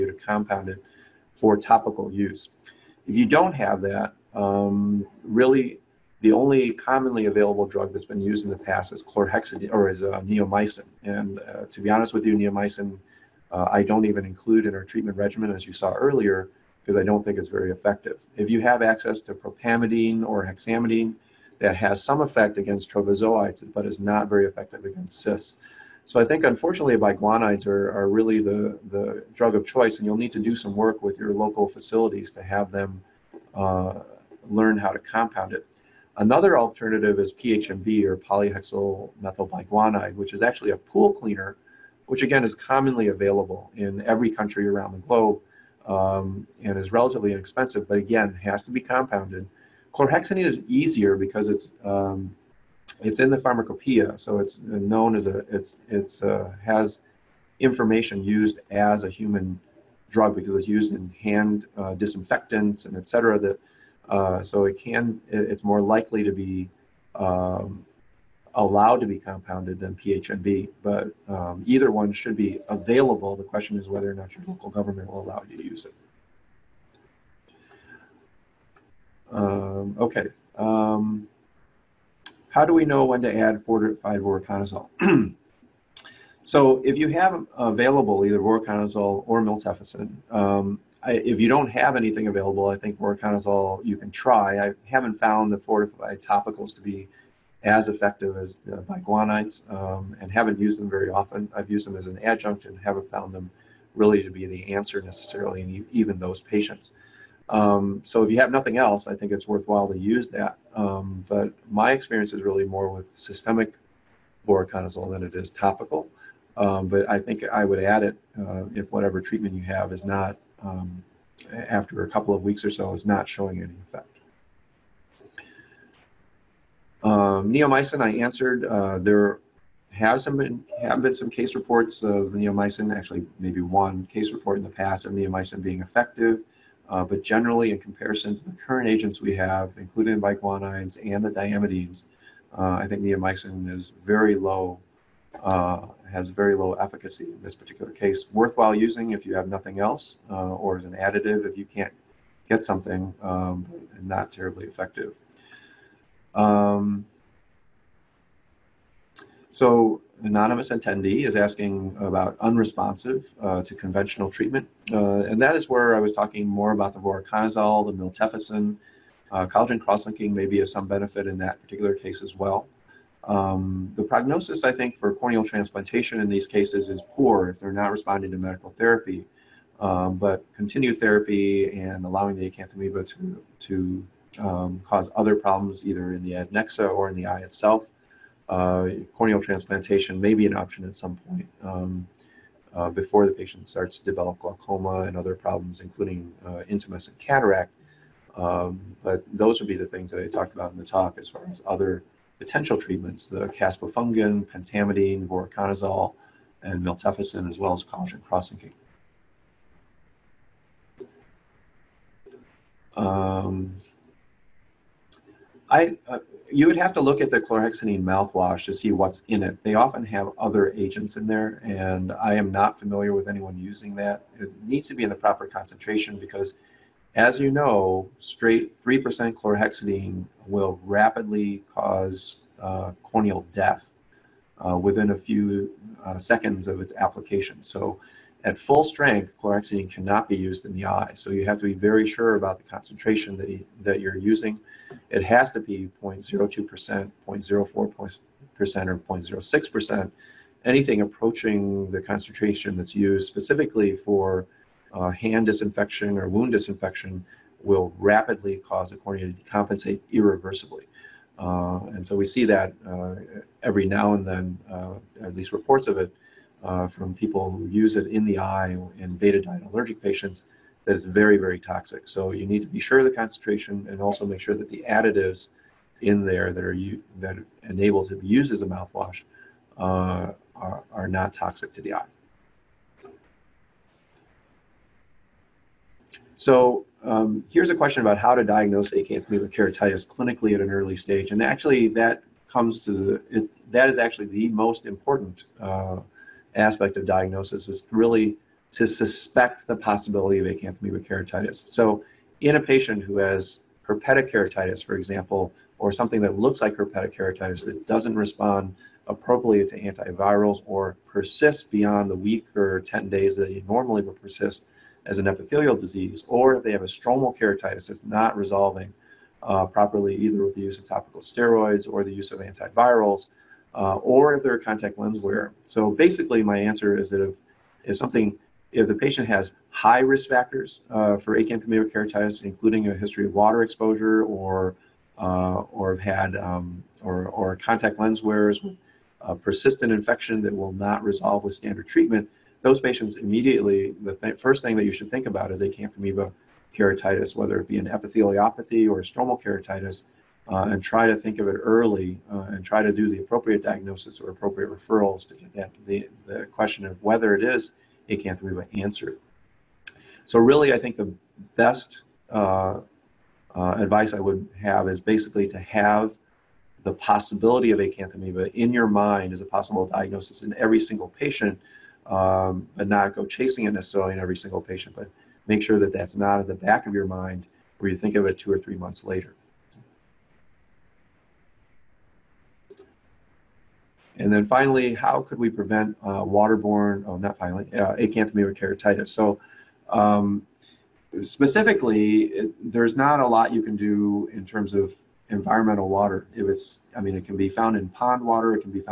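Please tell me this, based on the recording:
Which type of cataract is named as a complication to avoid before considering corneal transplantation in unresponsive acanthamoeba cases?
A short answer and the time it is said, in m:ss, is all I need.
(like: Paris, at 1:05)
Intumescent cataract, at 3:16.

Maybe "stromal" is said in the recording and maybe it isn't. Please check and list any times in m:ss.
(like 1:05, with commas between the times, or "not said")
5:16, 5:49.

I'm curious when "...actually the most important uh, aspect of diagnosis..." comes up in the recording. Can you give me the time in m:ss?
4:53.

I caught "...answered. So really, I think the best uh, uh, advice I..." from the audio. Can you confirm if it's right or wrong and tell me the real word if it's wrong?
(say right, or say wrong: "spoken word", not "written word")
right.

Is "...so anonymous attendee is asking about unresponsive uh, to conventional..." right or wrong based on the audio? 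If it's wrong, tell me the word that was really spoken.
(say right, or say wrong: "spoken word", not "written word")
right.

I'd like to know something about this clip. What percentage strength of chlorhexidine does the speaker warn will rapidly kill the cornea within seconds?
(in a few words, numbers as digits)
3%.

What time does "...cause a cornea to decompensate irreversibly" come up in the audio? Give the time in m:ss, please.
4:18.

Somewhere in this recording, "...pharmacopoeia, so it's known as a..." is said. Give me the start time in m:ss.
0:53.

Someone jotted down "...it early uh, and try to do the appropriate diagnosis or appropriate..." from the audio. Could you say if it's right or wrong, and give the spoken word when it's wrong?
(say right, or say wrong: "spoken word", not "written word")
right.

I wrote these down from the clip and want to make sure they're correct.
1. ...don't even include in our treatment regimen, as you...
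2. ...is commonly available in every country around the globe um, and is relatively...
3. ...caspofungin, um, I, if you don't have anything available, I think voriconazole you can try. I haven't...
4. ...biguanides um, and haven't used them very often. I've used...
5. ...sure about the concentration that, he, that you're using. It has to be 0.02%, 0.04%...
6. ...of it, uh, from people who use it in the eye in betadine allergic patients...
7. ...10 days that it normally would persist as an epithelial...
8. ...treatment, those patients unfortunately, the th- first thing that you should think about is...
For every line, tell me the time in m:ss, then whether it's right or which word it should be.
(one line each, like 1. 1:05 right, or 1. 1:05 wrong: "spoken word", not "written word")
1. 0:13 right
2. 0:42 right
3. 1:29 wrong: "miltefacin", not "caspofungin"
4. 1:38 right
5. 4:02 right
6. 4:25 right
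7. 5:12 right
8. 5:41 wrong: "immediately", not "unfortunately".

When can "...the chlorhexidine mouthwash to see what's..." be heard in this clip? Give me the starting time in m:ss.
3:37.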